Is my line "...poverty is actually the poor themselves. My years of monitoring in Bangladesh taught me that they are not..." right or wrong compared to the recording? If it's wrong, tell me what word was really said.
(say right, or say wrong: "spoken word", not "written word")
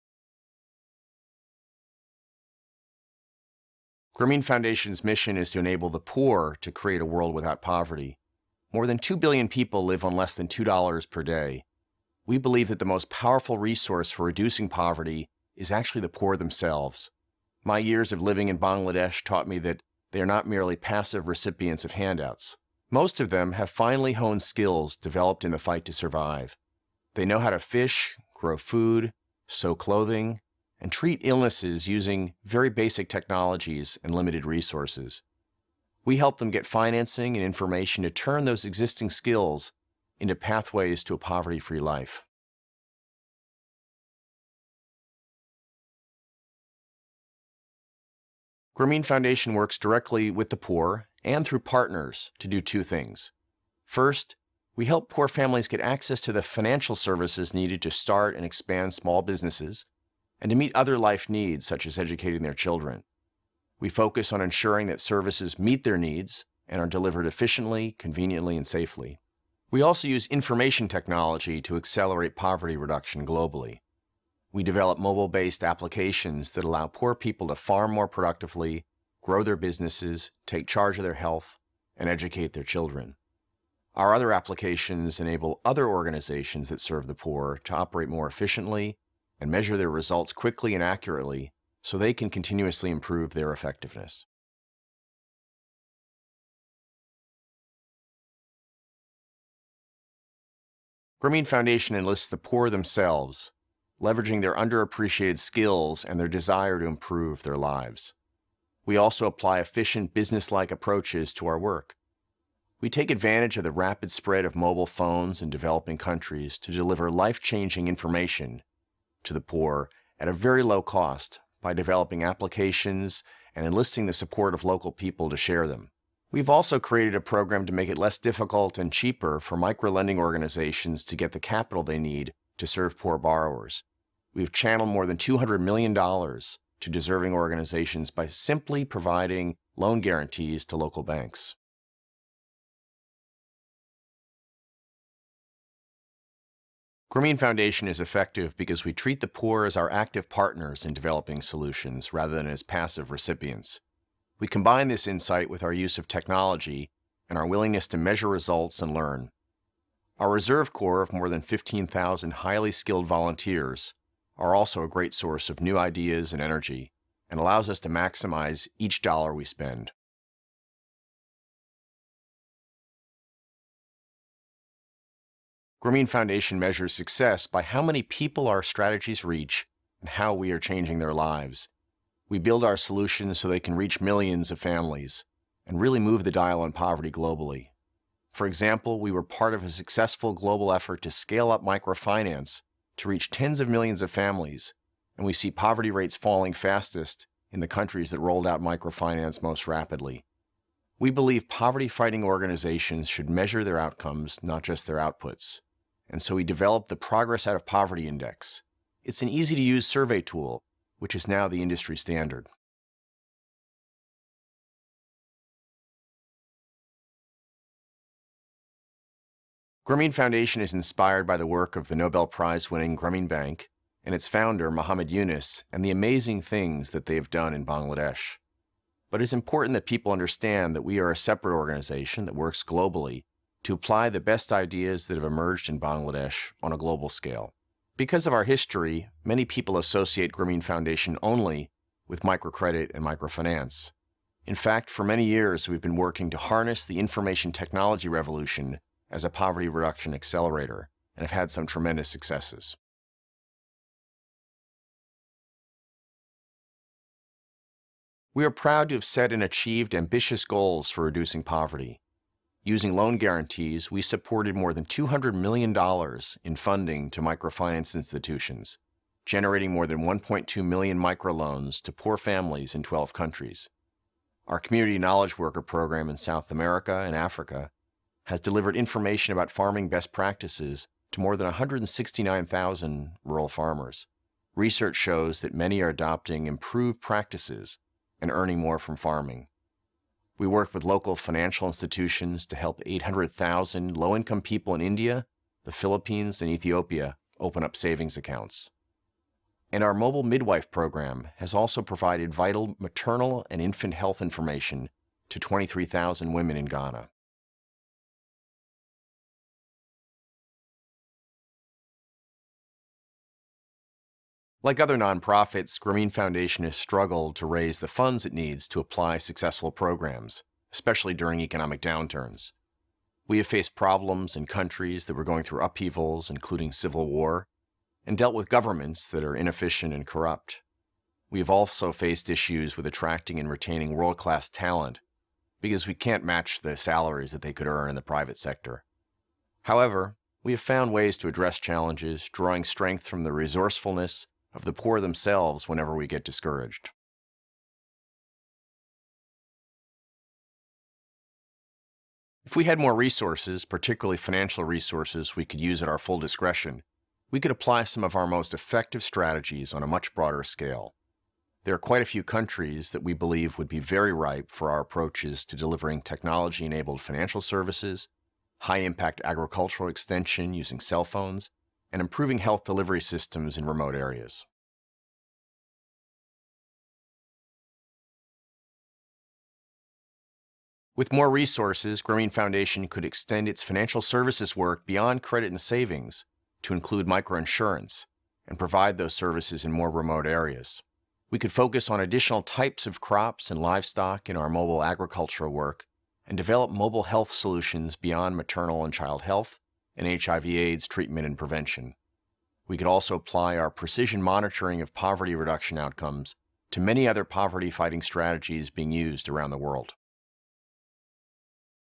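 wrong: "living", not "monitoring".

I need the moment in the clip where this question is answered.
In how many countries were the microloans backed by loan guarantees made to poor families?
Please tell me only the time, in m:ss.
4:32.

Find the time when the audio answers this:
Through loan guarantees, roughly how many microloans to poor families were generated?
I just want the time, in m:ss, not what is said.
4:30.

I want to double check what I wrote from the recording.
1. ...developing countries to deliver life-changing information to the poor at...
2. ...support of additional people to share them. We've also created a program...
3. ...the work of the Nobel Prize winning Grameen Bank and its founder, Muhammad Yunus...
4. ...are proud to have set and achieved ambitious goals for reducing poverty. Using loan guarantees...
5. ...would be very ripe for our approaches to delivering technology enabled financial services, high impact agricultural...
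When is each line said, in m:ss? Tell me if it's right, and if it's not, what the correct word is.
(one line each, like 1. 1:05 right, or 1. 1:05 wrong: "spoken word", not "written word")
1. 1:55 right
2. 2:04 wrong: "local", not "additional"
3. 3:41 right
4. 4:18 right
5. 6:03 right.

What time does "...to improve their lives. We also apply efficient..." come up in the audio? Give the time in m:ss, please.
1:46.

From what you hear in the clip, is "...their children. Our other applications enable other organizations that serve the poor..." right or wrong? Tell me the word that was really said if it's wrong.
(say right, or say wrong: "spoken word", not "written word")
right.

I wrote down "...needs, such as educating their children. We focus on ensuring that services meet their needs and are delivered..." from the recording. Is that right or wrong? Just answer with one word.
right.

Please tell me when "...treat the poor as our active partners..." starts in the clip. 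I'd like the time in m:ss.
2:28.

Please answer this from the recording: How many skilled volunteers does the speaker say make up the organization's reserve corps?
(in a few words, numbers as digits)
15,000.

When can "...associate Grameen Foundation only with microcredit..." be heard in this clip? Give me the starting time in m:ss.
3:59.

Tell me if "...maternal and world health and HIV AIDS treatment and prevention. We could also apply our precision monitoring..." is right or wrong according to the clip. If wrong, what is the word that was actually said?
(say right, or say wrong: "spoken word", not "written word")
wrong: "child", not "world".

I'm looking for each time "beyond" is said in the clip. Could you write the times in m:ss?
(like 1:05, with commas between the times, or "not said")
6:24, 6:37.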